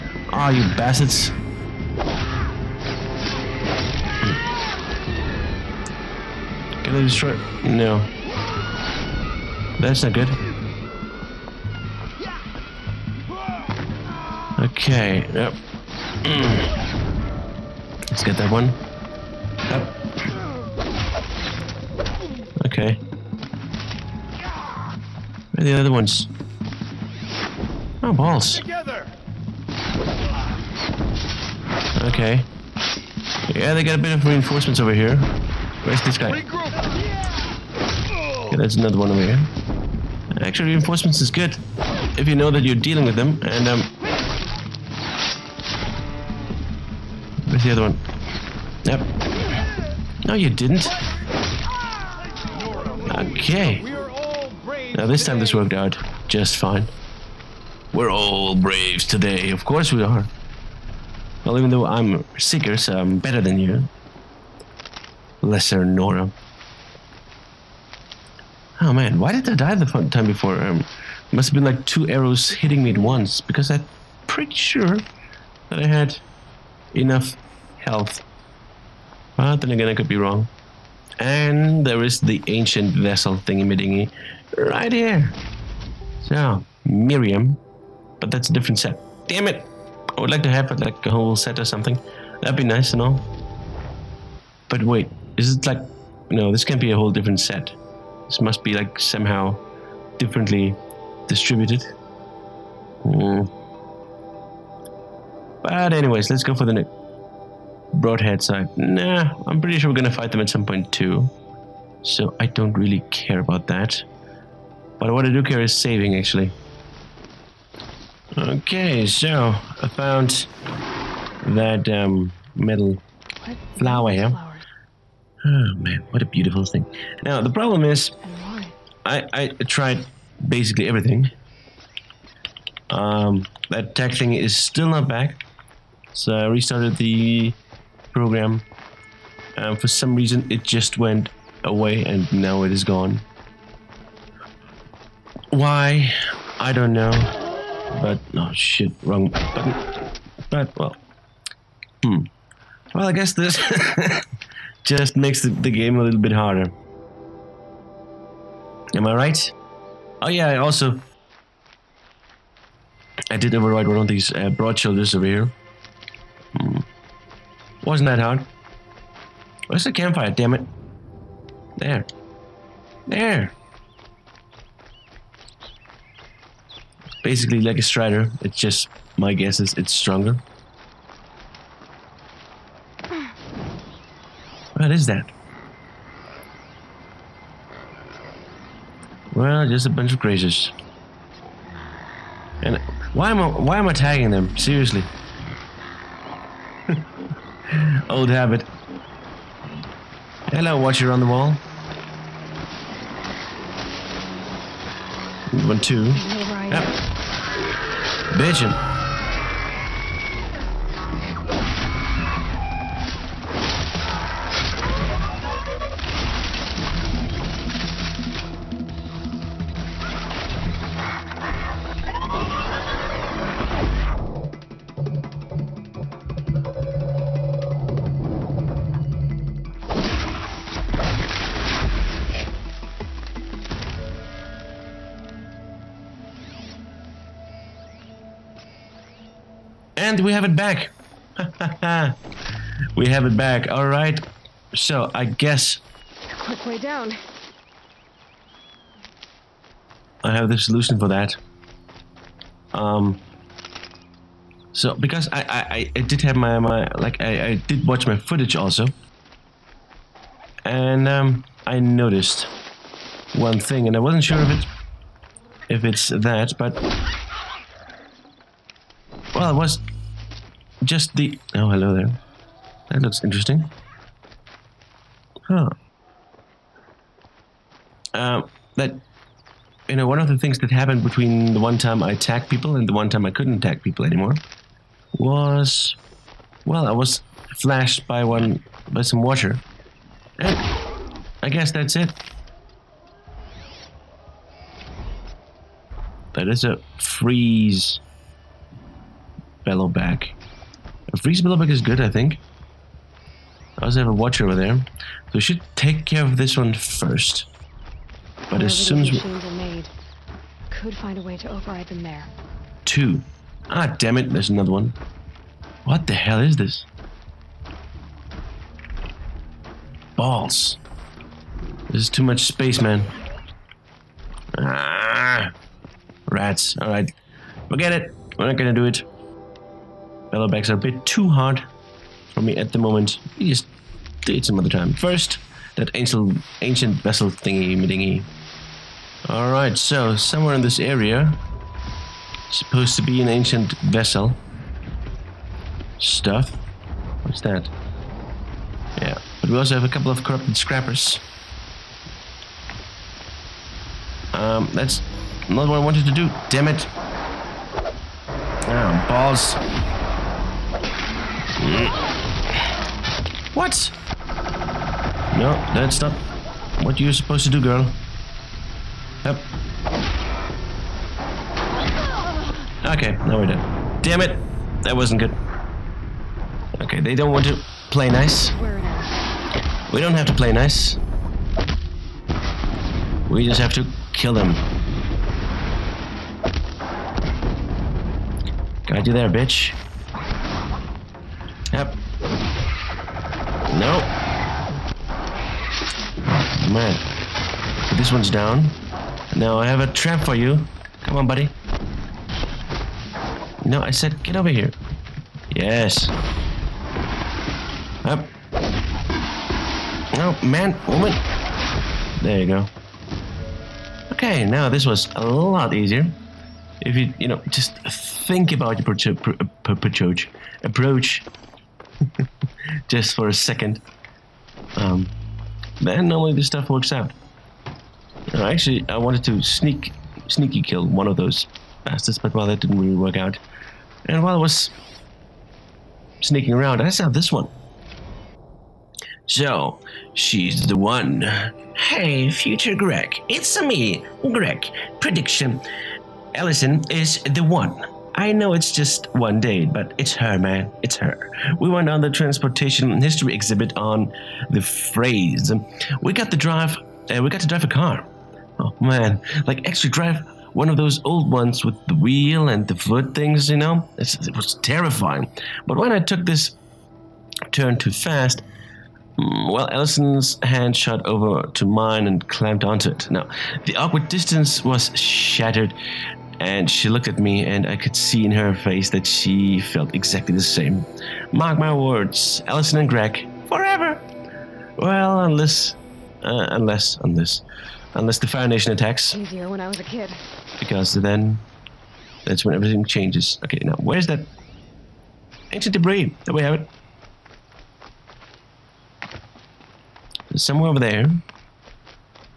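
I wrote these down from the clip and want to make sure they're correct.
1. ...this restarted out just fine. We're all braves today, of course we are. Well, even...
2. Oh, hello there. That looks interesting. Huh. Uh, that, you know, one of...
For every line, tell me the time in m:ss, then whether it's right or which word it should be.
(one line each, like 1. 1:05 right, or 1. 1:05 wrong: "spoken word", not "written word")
1. 0:55 wrong: "worked", not "restarted"
2. 4:31 right.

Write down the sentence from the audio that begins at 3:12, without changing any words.
And why am I why am I tagging them?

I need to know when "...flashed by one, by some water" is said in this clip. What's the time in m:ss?
4:47.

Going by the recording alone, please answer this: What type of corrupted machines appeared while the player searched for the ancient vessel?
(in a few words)
scrappers.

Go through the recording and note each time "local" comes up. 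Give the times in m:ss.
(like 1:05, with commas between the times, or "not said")
not said.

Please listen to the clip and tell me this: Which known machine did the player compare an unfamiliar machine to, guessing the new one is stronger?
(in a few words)
strider.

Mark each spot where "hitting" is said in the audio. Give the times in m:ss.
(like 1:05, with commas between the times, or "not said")
1:12.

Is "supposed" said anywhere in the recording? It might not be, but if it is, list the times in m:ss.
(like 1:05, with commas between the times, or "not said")
5:42, 6:07.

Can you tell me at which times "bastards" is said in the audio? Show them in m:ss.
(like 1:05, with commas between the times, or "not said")
0:00, 7:11.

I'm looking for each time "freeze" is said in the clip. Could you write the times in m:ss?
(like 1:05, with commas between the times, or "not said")
4:56, 5:01.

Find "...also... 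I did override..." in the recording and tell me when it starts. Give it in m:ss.
2:40.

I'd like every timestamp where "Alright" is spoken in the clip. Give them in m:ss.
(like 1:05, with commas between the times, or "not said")
5:26, 5:39.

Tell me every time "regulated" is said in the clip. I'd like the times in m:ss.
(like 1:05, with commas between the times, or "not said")
not said.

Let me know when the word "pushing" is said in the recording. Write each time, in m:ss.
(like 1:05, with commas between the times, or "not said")
not said.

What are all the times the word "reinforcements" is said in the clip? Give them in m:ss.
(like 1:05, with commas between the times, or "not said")
0:34, 0:40.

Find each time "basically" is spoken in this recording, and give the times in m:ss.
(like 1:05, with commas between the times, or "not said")
2:10, 2:57.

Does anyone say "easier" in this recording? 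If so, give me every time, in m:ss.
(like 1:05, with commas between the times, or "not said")
6:55, 8:09.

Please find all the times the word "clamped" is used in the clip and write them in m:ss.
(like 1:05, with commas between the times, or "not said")
7:52.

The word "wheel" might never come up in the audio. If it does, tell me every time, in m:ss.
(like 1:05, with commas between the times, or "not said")
7:41.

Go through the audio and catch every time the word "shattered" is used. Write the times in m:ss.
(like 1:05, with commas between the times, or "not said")
7:54.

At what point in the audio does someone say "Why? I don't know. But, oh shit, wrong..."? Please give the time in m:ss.
2:25.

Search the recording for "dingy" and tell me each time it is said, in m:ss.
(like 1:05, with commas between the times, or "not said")
1:23, 5:37.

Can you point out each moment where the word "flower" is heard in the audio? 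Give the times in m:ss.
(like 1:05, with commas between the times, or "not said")
2:03.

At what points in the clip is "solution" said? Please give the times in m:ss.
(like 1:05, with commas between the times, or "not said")
4:10.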